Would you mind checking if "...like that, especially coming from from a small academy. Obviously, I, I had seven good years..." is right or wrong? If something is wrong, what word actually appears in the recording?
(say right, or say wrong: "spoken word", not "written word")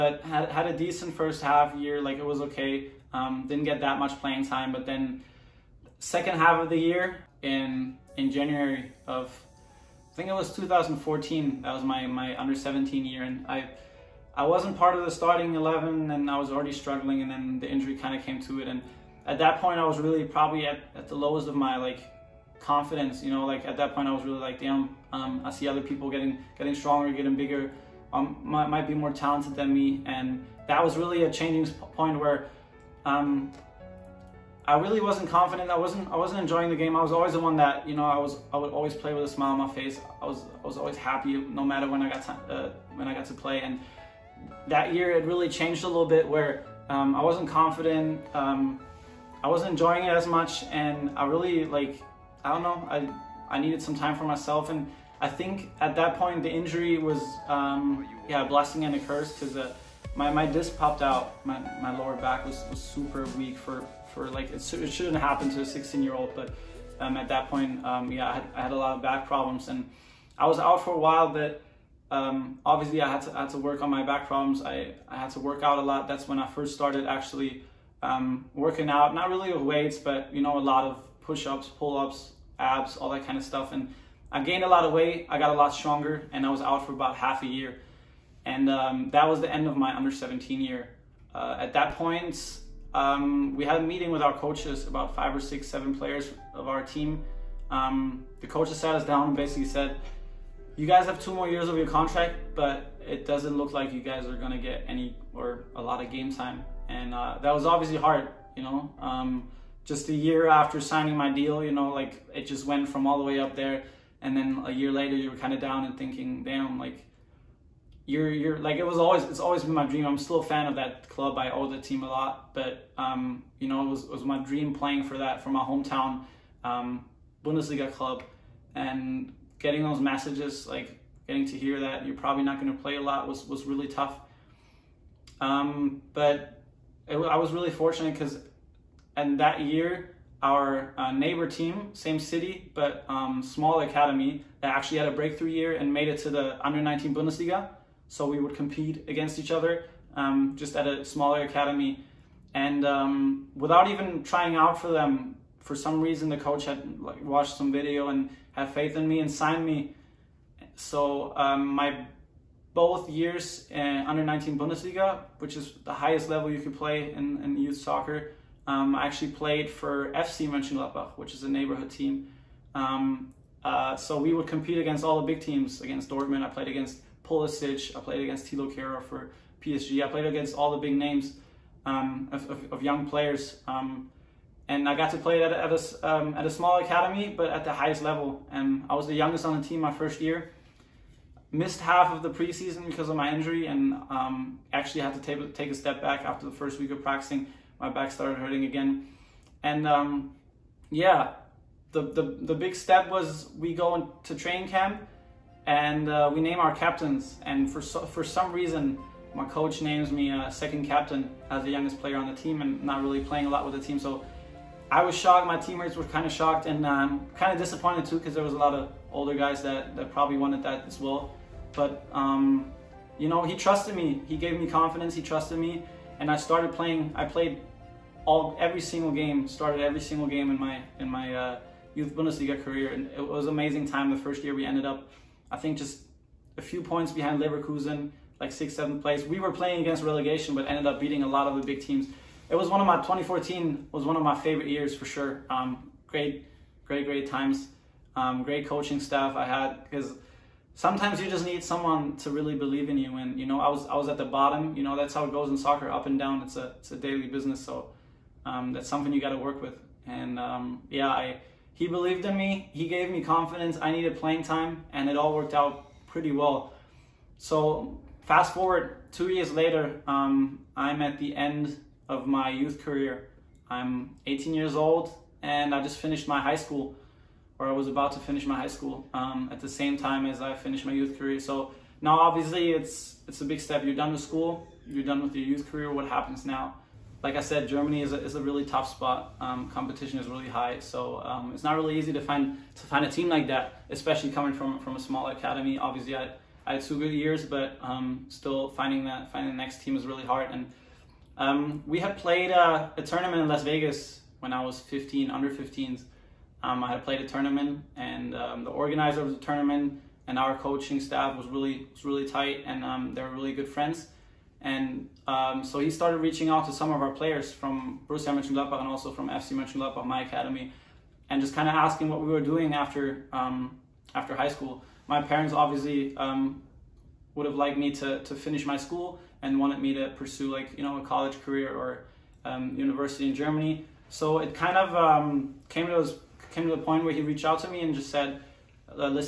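wrong: "two", not "seven".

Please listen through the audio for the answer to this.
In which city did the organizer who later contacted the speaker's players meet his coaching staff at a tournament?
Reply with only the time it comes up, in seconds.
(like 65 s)
303 s.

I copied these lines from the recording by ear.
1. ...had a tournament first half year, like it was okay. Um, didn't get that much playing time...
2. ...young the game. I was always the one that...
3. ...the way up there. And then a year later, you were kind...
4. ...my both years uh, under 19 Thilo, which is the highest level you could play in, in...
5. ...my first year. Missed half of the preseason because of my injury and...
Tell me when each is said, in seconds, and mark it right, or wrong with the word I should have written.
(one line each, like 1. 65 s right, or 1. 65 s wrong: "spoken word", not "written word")
1. 0 s wrong: "decent", not "tournament"
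2. 36 s wrong: "enjoying", not "young"
3. 113 s right
4. 161 s wrong: "Bundesliga", not "Thilo"
5. 189 s right.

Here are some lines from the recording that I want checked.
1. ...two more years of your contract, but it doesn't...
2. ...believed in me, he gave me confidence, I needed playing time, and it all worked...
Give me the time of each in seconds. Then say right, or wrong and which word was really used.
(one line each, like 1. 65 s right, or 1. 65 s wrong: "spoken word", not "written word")
1. 101 s right
2. 261 s right.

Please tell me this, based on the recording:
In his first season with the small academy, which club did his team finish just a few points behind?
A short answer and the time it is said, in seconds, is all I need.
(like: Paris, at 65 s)
Leverkusen, at 237 s.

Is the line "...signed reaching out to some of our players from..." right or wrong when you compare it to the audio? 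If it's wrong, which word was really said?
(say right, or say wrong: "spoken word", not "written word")
wrong: "started", not "signed".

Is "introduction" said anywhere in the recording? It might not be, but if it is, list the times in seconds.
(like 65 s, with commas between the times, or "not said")
not said.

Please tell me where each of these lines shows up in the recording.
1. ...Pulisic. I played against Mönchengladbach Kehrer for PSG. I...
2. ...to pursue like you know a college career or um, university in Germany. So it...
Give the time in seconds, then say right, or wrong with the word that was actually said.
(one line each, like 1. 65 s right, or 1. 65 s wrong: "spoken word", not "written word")
1. 177 s wrong: "Thilo", not "Mönchengladbach"
2. 329 s right.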